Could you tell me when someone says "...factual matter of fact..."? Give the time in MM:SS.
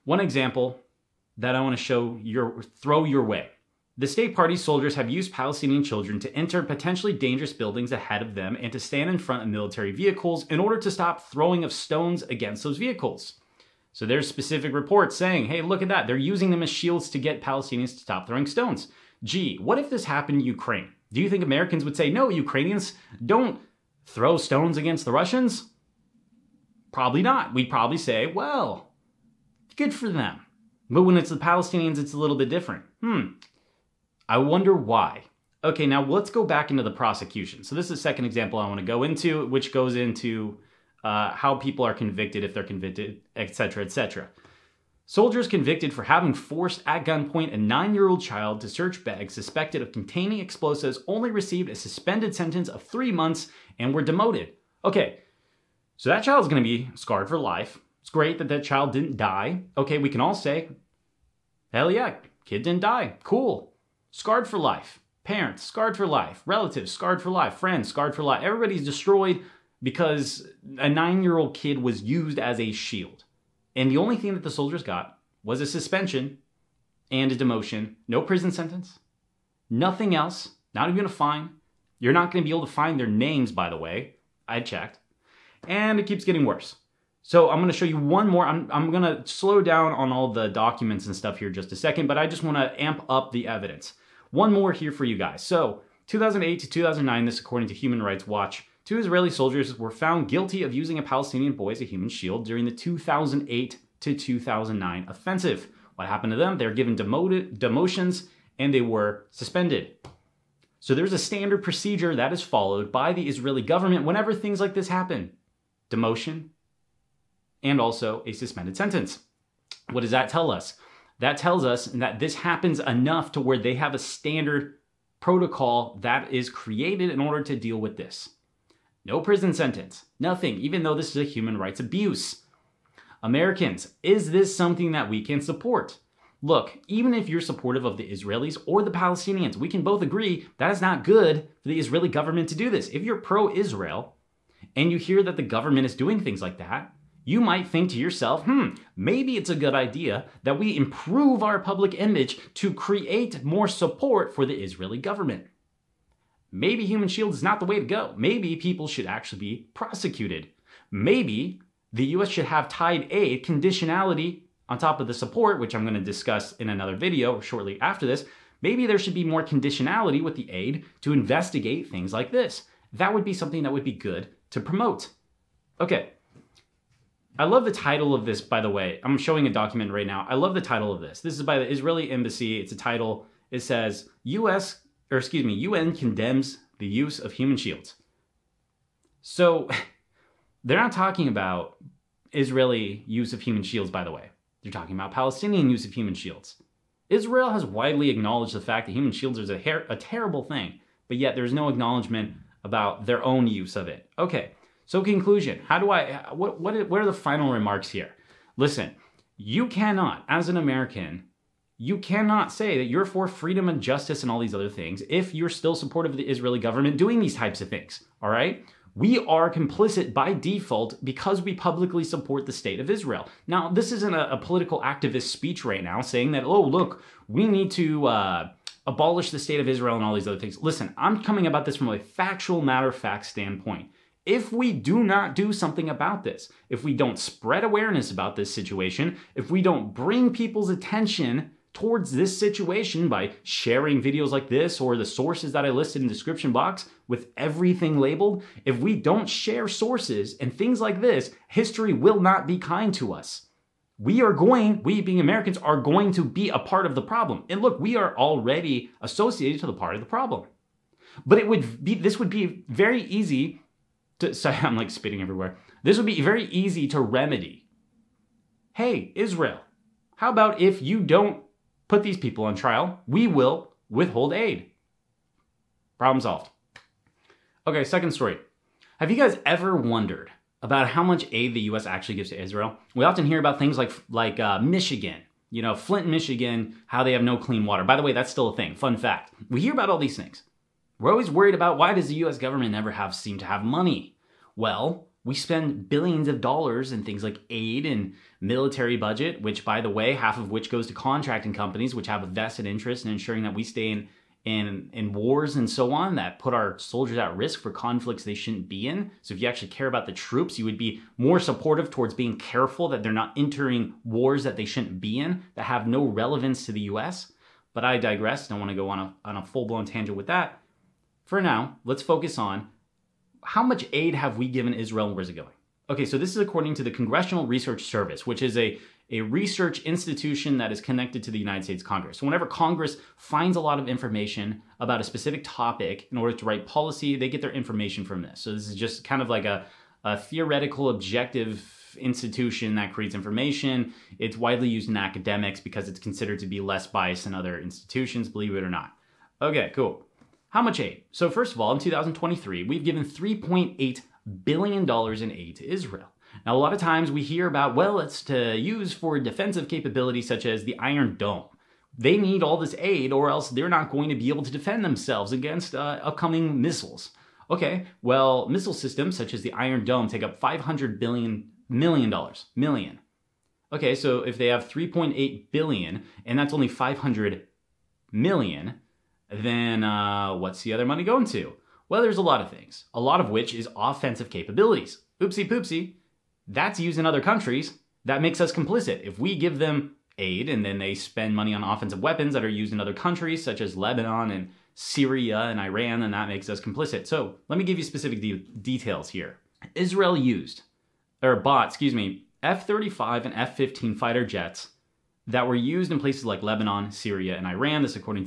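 03:51.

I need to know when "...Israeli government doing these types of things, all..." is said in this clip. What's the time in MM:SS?
03:36.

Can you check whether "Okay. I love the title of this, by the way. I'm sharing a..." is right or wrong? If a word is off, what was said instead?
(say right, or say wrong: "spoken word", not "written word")
wrong: "showing", not "sharing".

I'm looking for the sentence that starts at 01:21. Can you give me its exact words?
You're not going to be able to find their names, by the way.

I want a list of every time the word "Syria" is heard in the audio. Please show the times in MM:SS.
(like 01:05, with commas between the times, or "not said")
06:34, 06:46.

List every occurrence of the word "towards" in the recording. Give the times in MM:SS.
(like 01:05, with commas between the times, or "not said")
04:01, 05:11.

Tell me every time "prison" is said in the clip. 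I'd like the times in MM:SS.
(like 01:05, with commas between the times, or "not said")
01:18, 02:09.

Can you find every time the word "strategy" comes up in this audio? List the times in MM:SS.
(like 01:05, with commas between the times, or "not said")
not said.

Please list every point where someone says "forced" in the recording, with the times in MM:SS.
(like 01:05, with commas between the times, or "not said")
00:46.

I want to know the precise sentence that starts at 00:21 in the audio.
Do you think Americans would say, no, Ukrainians don't throw stones against the Russians?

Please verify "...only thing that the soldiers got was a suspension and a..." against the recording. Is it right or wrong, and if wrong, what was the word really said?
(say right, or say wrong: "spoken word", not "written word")
right.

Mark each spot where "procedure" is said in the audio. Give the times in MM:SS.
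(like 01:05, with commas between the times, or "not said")
01:51.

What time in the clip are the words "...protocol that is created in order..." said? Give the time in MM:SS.
02:05.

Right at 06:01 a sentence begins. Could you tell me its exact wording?
They need all this aid, or else they're not going to be able to defend themselves against uh, upcoming missiles.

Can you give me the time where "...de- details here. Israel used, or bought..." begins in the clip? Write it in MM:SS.
06:38.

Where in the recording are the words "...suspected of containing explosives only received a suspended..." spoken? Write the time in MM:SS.
00:49.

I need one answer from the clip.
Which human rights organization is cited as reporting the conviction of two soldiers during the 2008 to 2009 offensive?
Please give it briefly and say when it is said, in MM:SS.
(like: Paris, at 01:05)
Human Rights Watch, at 01:37.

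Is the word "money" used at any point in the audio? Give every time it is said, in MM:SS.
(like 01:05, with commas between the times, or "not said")
04:53, 06:20, 06:31.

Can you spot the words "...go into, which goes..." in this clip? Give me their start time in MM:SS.
00:38.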